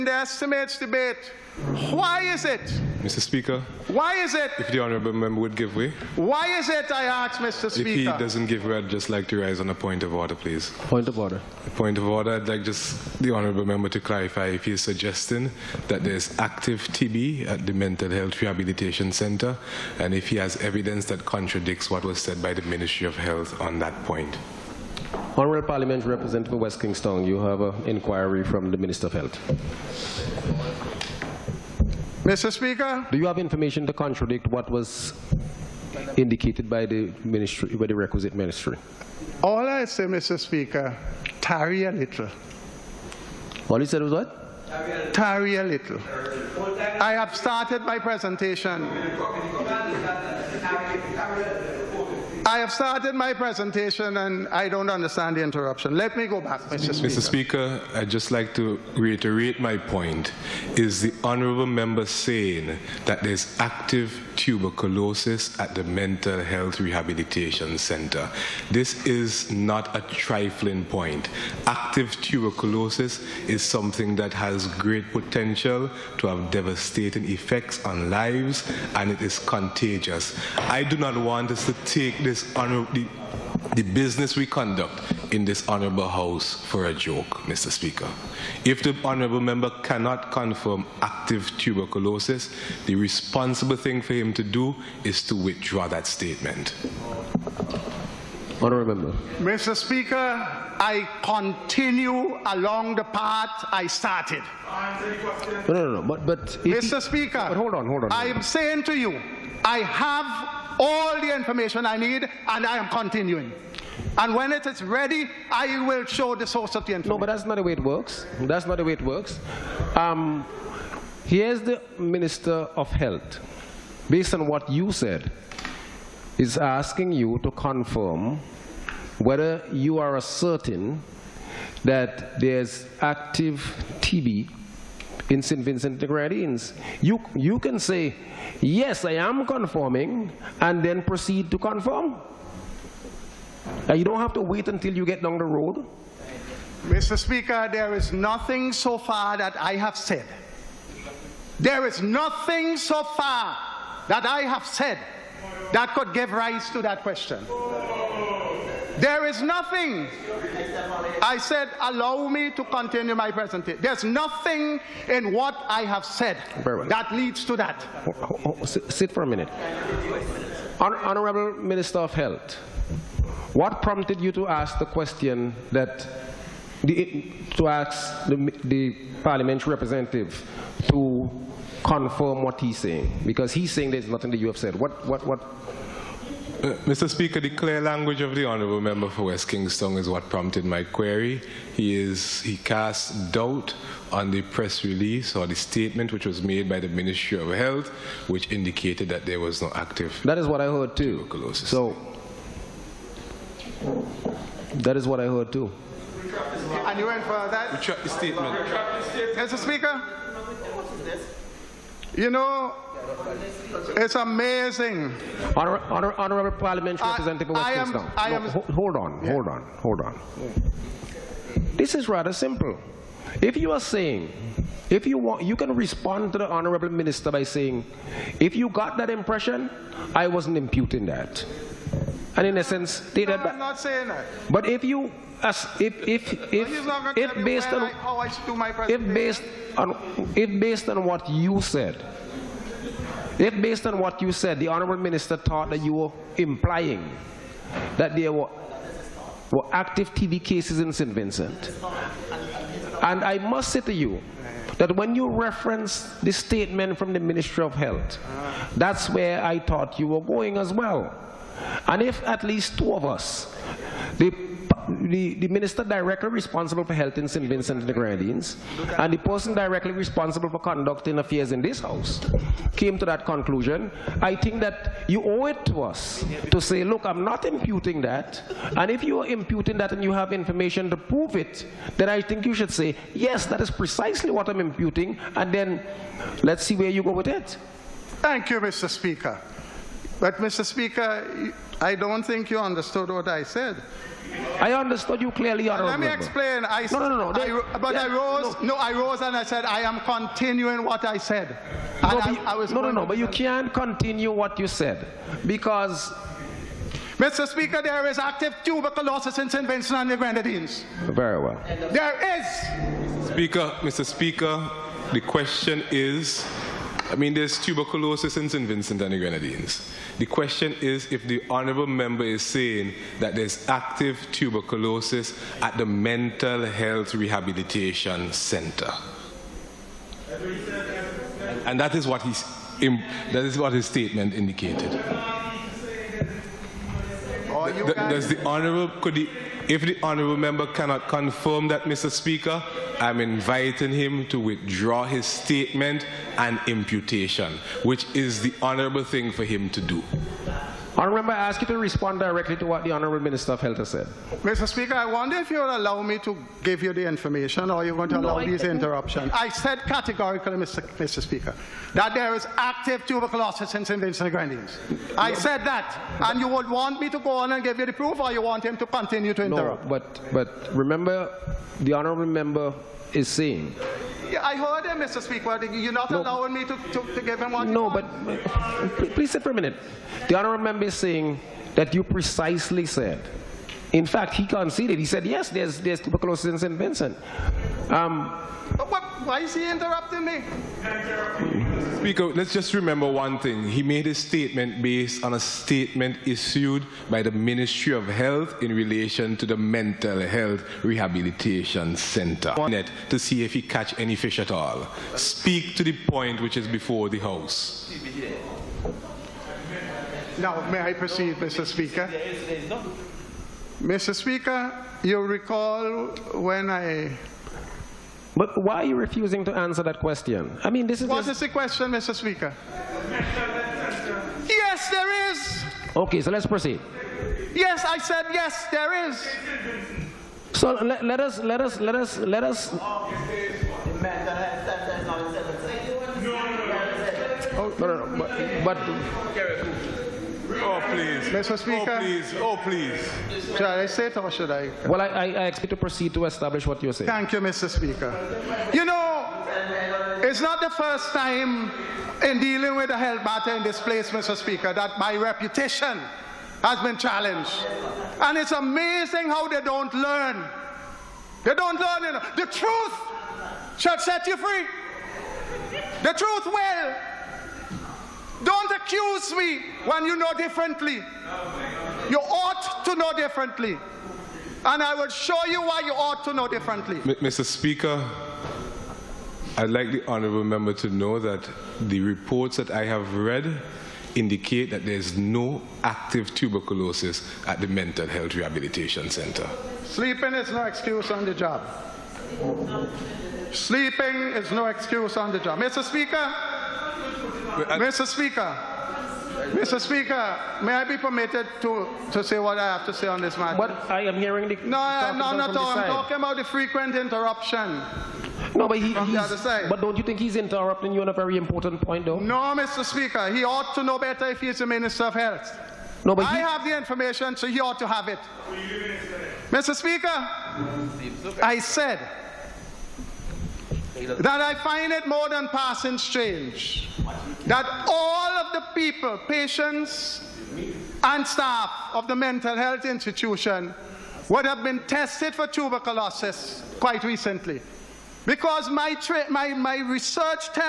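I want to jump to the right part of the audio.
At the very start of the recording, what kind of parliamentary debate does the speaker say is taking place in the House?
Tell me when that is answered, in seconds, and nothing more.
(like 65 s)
0 s.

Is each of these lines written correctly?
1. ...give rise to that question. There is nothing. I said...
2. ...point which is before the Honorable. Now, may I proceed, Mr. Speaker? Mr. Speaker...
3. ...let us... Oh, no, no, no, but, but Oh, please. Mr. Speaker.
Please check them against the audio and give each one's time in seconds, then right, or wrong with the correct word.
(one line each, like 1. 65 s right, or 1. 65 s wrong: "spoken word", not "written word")
1. 156 s right
2. 406 s wrong: "House", not "Honorable"
3. 432 s right.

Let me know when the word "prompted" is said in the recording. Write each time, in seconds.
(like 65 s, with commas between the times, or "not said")
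173 s, 190 s.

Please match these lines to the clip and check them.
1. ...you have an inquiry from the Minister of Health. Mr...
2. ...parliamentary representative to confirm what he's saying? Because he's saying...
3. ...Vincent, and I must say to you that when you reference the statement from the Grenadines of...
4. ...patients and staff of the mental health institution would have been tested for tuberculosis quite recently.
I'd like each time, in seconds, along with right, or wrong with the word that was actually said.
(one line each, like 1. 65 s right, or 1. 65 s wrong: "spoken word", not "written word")
1. 27 s right
2. 179 s right
3. 251 s wrong: "Ministry", not "Grenadines"
4. 529 s right.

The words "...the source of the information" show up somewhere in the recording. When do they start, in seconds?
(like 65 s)
116 s.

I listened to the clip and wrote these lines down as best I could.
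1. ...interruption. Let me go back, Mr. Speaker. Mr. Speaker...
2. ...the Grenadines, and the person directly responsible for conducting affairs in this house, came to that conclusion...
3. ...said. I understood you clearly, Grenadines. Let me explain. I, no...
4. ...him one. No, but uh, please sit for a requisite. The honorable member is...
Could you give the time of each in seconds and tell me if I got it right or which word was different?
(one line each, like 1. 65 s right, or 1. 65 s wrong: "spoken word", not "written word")
1. 55 s right
2. 267 s right
3. 293 s wrong: "Honorable", not "Grenadines"
4. 377 s wrong: "minute", not "requisite".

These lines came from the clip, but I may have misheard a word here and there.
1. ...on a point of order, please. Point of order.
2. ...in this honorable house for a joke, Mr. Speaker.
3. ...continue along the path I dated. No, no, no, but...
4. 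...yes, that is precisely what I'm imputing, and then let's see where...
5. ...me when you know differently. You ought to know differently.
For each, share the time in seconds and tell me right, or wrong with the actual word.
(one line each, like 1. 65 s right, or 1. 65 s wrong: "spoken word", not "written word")
1. 9 s right
2. 85 s right
3. 101 s wrong: "started", not "dated"
4. 283 s right
5. 469 s right.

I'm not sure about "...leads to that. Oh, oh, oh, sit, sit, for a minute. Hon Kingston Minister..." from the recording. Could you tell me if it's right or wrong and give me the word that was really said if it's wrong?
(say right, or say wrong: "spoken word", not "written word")
wrong: "Honorable", not "Kingston".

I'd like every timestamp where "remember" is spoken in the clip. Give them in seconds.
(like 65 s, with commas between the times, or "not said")
370 s, 392 s.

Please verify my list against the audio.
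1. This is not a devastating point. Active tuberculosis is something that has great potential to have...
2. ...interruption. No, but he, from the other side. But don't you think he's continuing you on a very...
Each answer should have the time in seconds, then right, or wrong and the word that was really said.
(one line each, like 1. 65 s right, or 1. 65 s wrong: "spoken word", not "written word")
1. 68 s wrong: "trifling", not "devastating"
2. 506 s wrong: "interrupting", not "continuing".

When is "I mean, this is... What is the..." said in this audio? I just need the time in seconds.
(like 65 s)
420 s.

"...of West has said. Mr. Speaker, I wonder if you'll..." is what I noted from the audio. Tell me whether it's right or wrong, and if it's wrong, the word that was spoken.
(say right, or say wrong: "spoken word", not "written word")
wrong: "Health", not "West".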